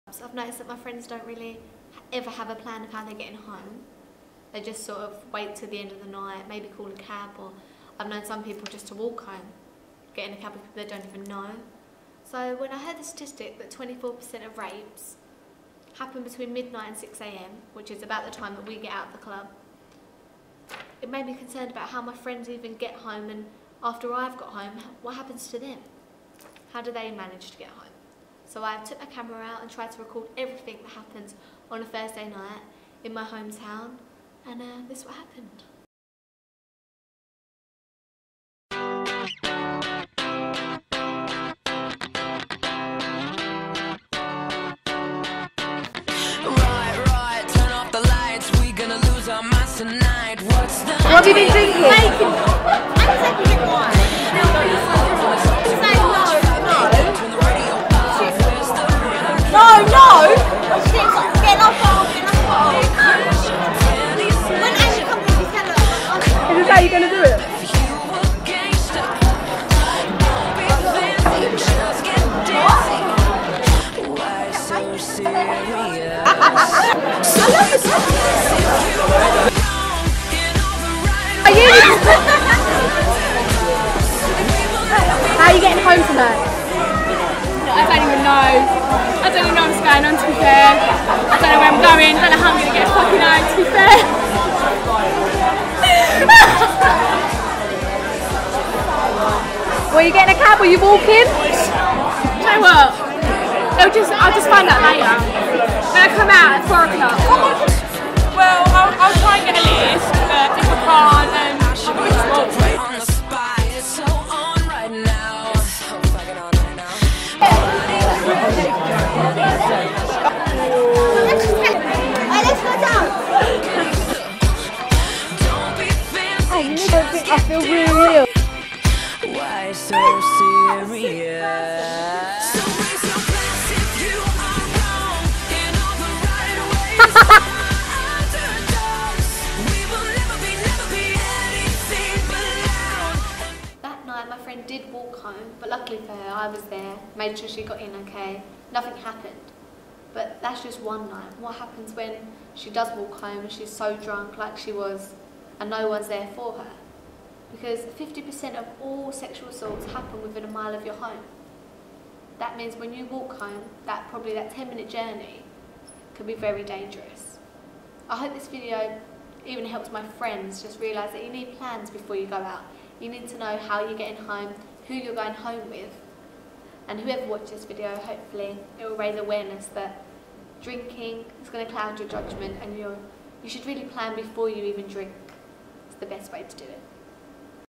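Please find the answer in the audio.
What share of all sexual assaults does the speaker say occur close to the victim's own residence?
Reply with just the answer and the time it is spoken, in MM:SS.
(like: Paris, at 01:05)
50%, at 02:37.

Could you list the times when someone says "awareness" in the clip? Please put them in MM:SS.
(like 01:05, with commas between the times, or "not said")
02:59.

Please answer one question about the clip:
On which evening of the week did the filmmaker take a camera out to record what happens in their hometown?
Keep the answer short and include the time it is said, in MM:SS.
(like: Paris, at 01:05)
Thursday, at 00:31.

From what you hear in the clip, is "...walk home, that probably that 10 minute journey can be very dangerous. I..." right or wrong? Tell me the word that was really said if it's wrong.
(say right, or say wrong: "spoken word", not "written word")
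right.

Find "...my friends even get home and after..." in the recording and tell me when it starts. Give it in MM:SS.
00:22.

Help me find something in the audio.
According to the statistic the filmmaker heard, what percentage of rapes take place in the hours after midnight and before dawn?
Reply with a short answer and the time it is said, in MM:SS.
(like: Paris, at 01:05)
24%, at 00:13.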